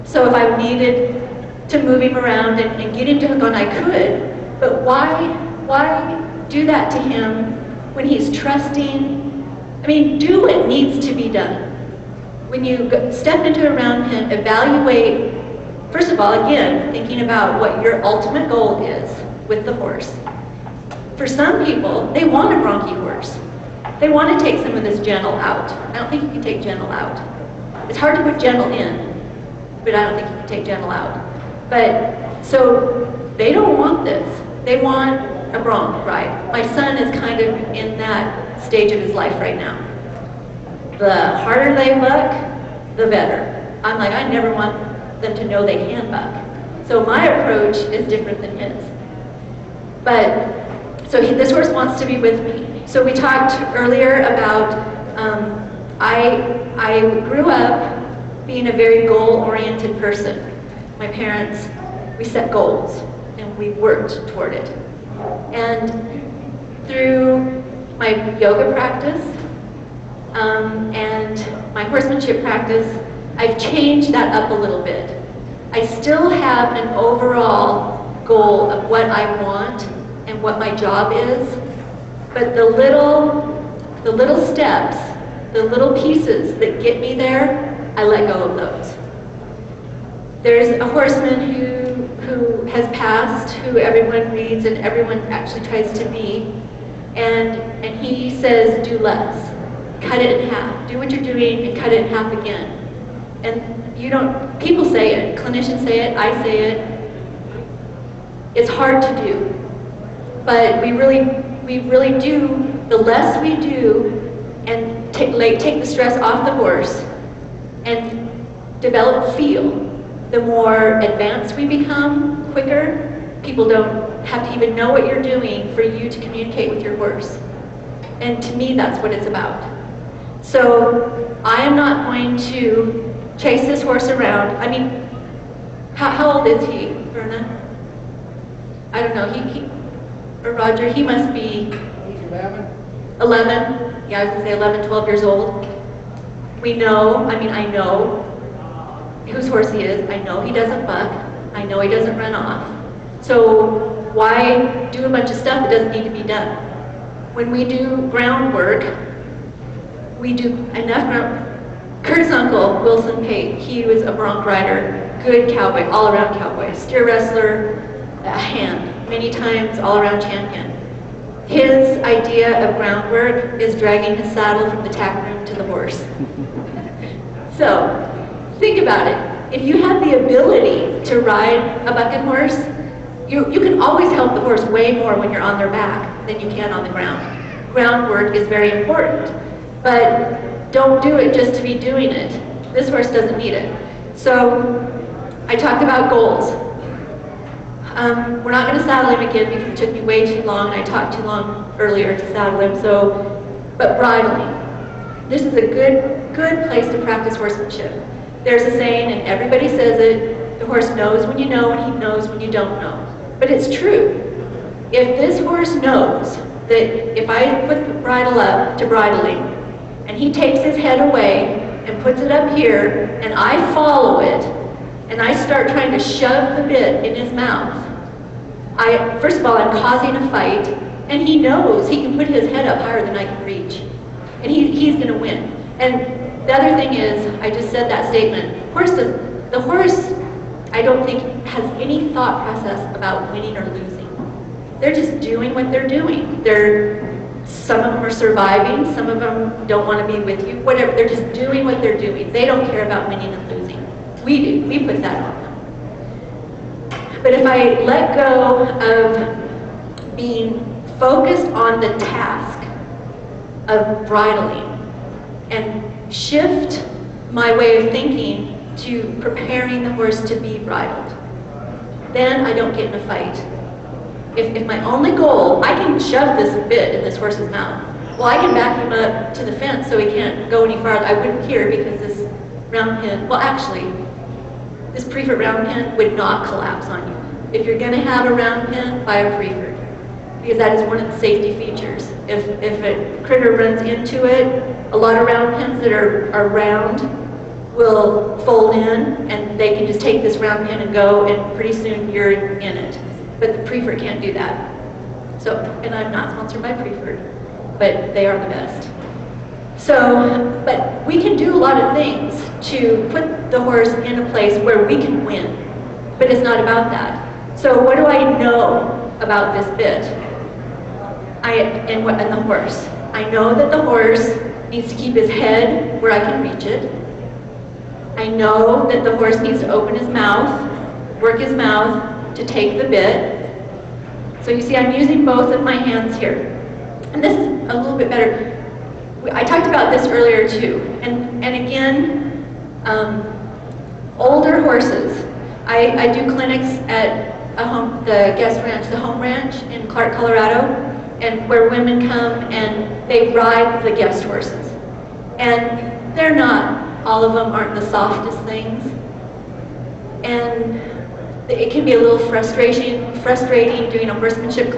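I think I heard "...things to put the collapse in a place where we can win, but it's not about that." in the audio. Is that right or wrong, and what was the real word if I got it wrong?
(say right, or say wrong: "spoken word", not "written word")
wrong: "horse", not "collapse".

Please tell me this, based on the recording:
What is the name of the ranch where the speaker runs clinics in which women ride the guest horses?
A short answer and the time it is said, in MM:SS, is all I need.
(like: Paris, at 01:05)
The Home Ranch, at 05:48.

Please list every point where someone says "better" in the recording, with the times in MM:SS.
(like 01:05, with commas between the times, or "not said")
00:43, 05:38.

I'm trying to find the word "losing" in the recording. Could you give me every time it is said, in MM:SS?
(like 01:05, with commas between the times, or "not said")
04:03, 04:13.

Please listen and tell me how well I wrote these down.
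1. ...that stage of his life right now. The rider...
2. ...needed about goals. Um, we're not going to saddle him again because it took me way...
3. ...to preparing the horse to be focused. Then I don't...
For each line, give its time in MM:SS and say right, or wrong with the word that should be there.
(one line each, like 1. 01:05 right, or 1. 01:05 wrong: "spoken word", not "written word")
1. 00:37 wrong: "harder", not "rider"
2. 03:15 wrong: "talked", not "needed"
3. 04:28 wrong: "bridled", not "focused".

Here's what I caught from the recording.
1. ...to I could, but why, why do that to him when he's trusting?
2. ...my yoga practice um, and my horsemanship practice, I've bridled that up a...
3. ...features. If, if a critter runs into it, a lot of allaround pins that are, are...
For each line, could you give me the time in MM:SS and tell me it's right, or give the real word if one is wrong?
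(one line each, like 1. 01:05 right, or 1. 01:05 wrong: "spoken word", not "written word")
1. 00:03 right
2. 01:07 wrong: "changed", not "bridled"
3. 04:51 wrong: "round", not "allaround".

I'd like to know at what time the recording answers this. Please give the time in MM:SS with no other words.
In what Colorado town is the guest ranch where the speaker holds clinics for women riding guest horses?
05:49.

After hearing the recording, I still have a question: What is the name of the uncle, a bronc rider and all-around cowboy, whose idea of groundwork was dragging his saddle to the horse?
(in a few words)
Wilson Pate.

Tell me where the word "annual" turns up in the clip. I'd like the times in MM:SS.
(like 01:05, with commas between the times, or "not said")
not said.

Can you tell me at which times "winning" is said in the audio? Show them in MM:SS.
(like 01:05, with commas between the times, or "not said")
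04:03, 04:13.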